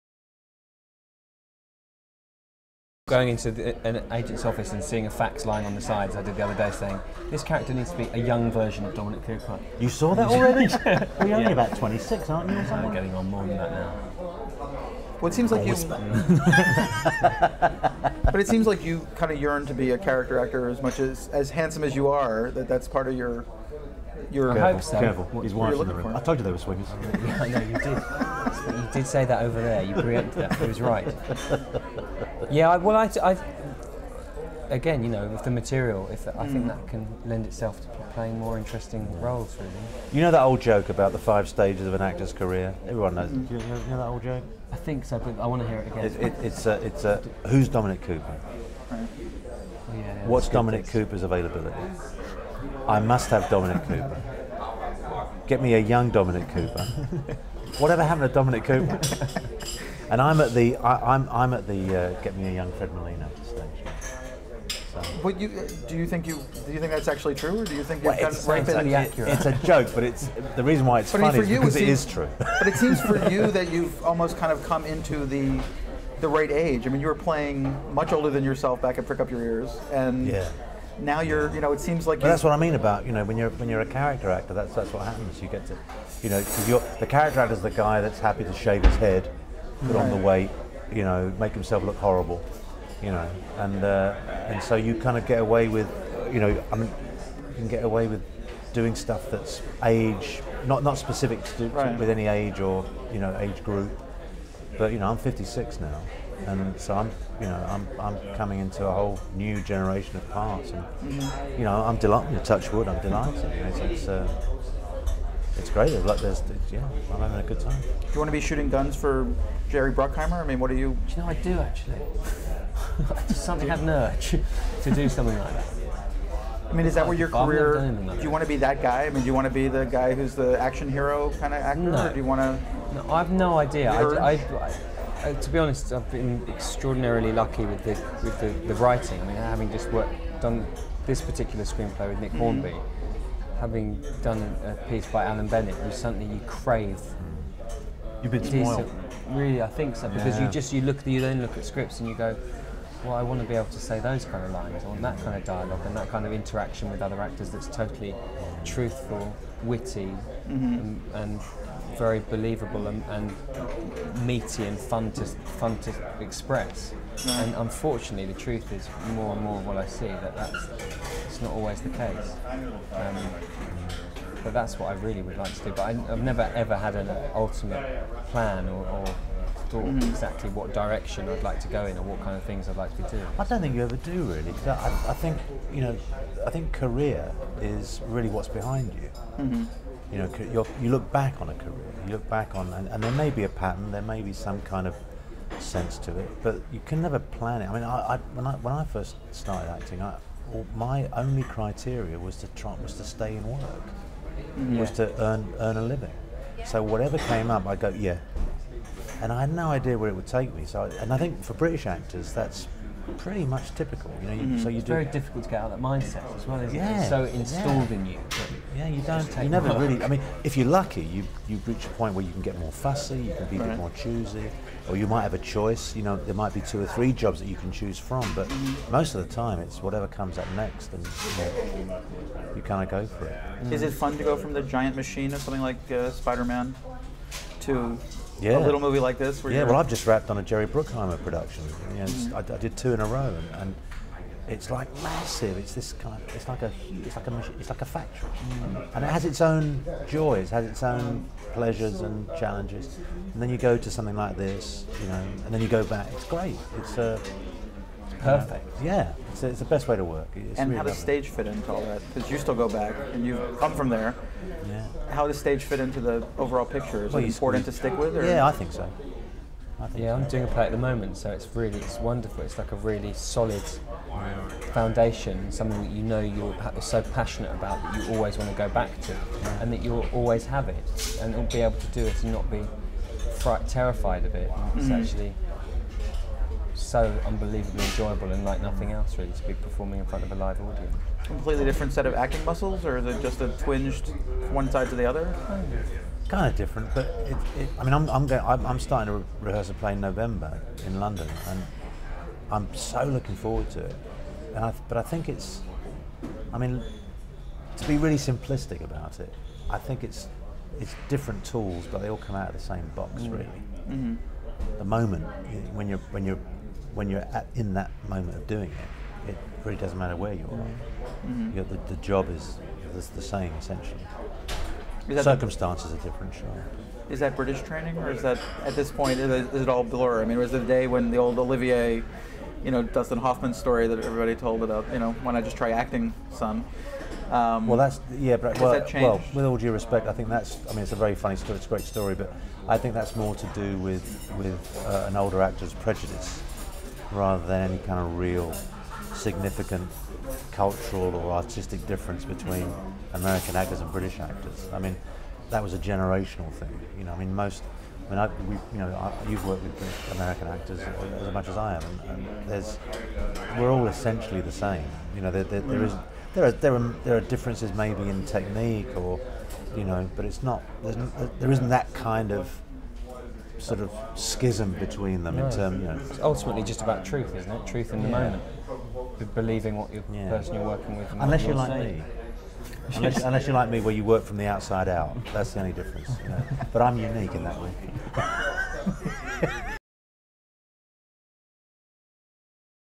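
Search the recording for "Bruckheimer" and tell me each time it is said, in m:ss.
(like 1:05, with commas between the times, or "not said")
1:59, 4:00.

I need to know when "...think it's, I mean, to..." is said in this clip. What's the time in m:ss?
5:05.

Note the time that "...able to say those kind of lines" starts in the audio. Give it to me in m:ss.
2:33.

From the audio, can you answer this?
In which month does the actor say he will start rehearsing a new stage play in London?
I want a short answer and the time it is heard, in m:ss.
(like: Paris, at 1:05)
November, at 4:59.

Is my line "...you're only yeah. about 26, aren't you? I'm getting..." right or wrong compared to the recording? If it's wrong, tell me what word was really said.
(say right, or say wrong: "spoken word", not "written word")
right.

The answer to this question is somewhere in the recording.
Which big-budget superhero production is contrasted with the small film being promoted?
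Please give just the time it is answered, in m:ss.
3:56.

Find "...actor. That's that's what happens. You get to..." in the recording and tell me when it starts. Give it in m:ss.
1:24.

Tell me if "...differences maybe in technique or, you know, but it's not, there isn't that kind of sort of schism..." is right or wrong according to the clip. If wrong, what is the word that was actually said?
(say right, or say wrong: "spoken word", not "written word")
right.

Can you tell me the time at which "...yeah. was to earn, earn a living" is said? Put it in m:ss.
3:24.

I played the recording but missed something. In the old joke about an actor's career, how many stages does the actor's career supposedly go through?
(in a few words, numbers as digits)
5.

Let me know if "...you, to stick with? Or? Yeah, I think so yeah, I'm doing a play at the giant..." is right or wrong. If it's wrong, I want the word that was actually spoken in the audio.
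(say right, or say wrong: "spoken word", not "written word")
wrong: "moment", not "giant".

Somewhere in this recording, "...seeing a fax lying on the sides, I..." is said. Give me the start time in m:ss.
0:04.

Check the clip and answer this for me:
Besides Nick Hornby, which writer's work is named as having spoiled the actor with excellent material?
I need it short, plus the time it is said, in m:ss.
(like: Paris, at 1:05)
Alan Bennett, at 2:25.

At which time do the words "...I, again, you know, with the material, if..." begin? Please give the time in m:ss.
0:33.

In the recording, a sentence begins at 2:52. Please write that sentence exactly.
Um, but that's what I really would like to do.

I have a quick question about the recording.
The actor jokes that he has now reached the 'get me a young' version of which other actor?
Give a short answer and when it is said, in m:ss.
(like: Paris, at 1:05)
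Fred Molina, at 1:02.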